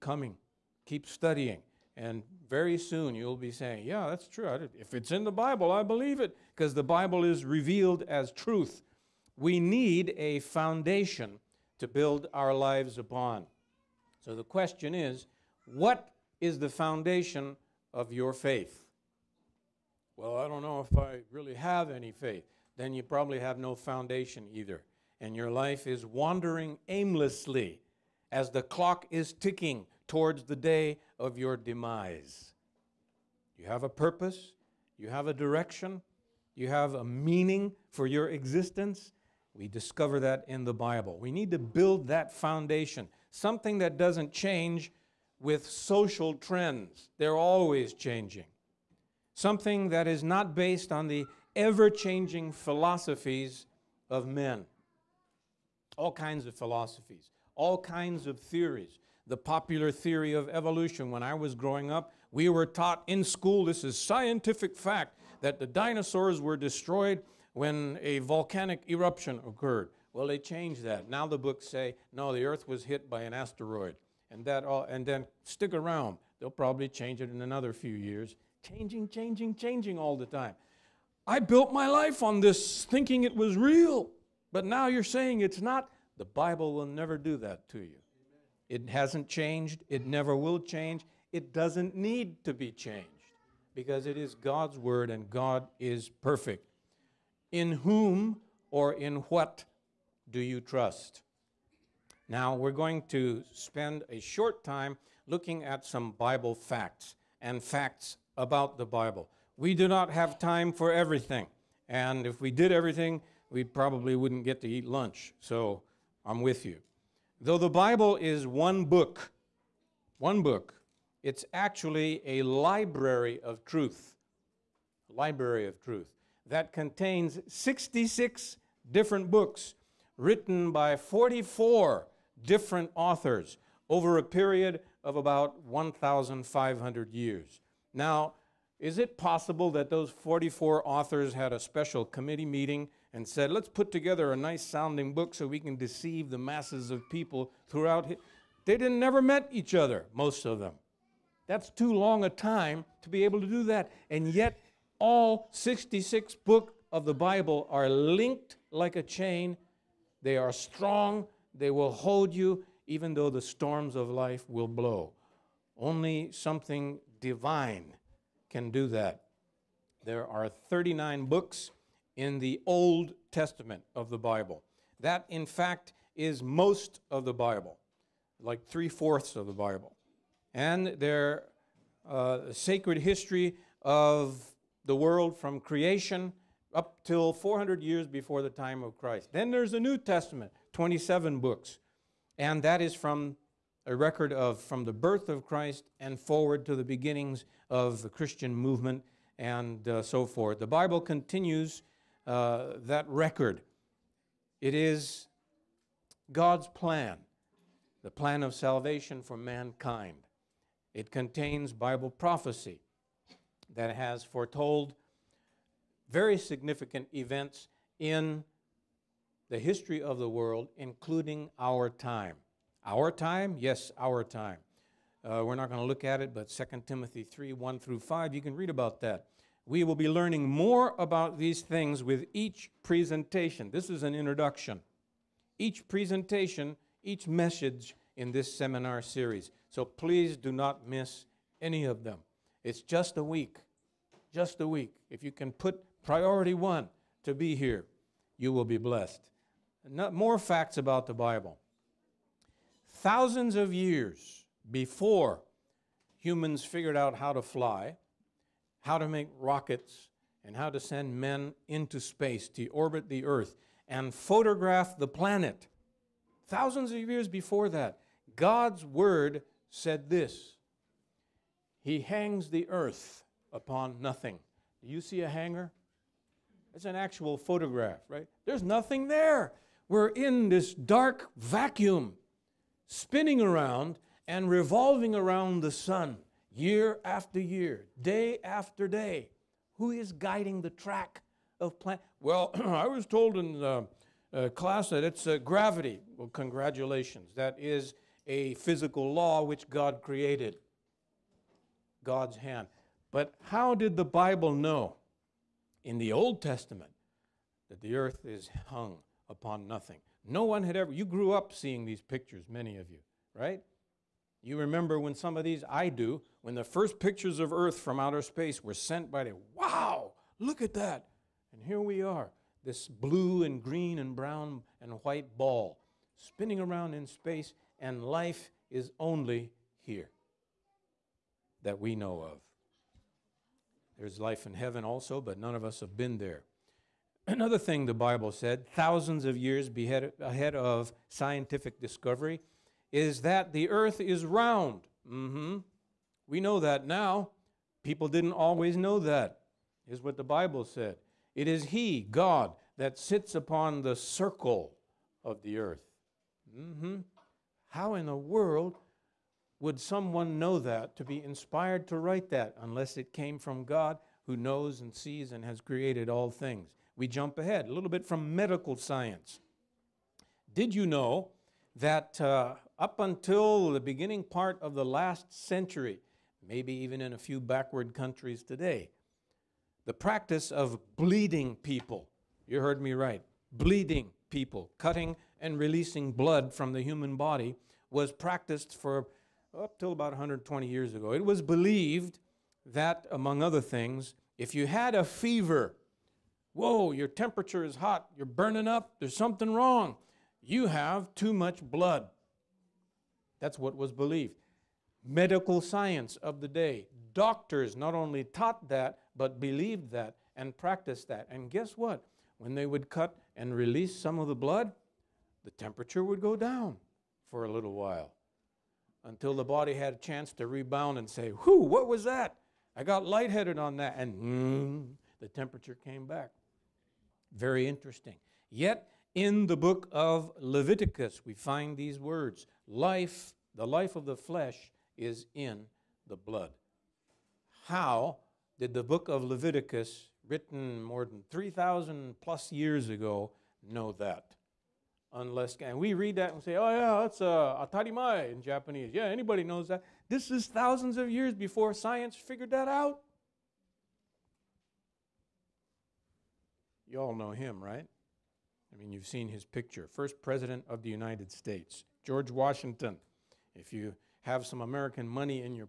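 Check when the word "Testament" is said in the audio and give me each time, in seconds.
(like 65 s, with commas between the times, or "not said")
173 s, 189 s, 306 s.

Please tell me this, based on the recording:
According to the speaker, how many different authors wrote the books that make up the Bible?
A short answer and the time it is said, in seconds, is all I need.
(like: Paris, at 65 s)
44, at 130 s.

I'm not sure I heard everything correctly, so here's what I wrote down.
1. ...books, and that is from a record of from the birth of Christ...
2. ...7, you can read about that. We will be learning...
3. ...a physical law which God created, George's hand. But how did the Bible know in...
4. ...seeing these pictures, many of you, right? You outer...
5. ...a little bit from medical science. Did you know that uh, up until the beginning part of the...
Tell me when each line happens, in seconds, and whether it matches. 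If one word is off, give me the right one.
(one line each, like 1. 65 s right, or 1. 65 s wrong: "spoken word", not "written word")
1. 191 s right
2. 227 s wrong: "5", not "7"
3. 298 s wrong: "God", not "George"
4. 311 s wrong: "remember", not "outer"
5. 367 s right.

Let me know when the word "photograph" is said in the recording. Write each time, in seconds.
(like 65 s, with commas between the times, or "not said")
264 s, 277 s.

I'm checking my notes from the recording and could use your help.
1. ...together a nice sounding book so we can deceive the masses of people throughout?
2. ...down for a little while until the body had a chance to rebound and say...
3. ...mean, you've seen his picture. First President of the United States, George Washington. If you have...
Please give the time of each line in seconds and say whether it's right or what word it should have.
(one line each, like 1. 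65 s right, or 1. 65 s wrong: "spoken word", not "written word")
1. 143 s right
2. 416 s right
3. 458 s right.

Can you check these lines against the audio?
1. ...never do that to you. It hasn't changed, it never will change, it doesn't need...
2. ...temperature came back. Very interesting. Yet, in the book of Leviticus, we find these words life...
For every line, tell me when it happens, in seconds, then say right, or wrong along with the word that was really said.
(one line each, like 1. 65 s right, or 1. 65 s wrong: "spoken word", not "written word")
1. 86 s right
2. 425 s right.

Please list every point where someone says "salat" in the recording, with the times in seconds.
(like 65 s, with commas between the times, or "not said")
not said.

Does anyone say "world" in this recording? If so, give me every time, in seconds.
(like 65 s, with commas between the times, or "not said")
184 s, 220 s, 358 s.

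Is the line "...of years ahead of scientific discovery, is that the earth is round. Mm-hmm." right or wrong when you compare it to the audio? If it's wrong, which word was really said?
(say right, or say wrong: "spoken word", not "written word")
right.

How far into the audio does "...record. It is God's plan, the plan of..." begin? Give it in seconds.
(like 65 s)
203 s.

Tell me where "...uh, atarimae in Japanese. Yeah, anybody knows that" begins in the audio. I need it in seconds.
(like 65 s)
447 s.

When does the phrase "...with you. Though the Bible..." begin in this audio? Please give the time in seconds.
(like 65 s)
116 s.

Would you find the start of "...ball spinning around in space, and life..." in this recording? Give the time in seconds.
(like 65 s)
325 s.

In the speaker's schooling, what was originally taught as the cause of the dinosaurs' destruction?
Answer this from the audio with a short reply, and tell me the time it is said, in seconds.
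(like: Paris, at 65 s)
volcanic eruption, at 68 s.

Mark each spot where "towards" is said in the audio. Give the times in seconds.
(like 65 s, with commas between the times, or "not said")
30 s.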